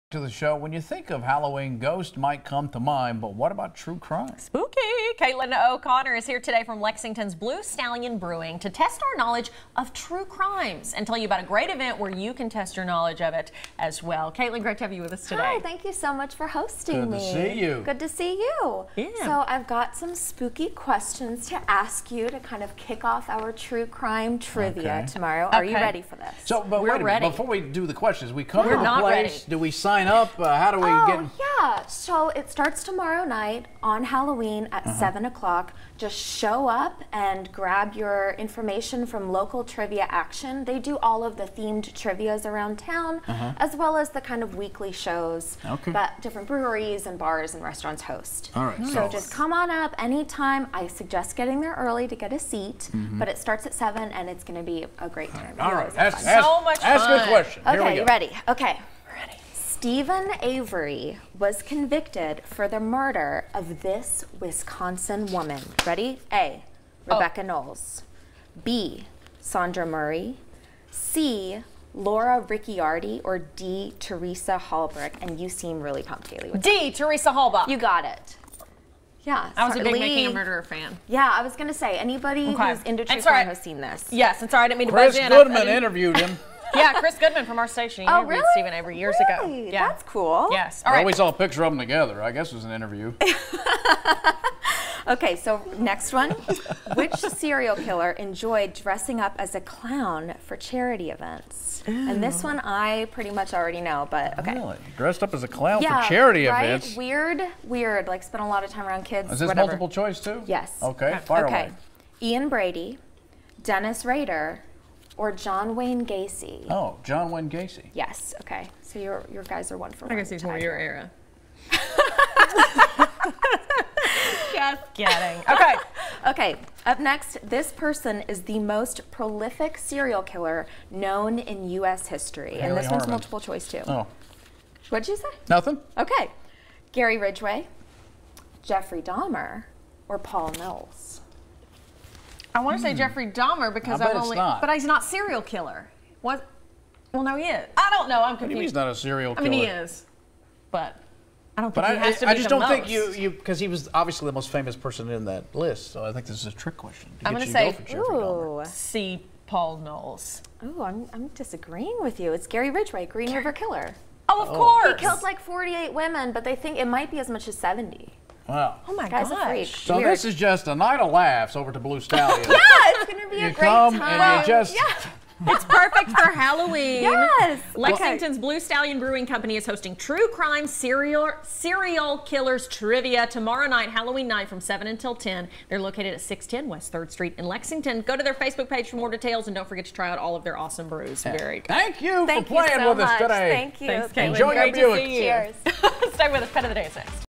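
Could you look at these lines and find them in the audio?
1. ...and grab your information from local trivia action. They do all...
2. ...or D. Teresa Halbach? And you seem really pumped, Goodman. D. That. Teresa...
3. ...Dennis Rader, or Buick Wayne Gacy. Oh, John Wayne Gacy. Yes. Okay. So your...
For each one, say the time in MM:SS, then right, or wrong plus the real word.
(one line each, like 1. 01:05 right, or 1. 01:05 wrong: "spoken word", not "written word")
1. 00:37 right
2. 01:13 wrong: "Hayley", not "Goodman"
3. 01:53 wrong: "John", not "Buick".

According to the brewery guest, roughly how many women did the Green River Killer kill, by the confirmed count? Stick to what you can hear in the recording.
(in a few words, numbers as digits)
48.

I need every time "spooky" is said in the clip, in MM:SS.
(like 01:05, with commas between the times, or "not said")
00:04, 00:20.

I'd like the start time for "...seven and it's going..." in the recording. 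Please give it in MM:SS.
00:53.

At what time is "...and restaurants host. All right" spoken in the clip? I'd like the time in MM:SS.
00:47.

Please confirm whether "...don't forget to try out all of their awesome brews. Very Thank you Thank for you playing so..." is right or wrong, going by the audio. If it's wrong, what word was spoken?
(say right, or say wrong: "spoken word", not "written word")
right.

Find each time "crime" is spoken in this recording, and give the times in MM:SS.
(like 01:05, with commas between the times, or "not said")
00:03, 00:10, 00:23, 01:23, 03:00.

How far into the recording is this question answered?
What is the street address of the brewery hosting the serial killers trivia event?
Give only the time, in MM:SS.
03:06.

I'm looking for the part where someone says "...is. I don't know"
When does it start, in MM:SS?
02:27.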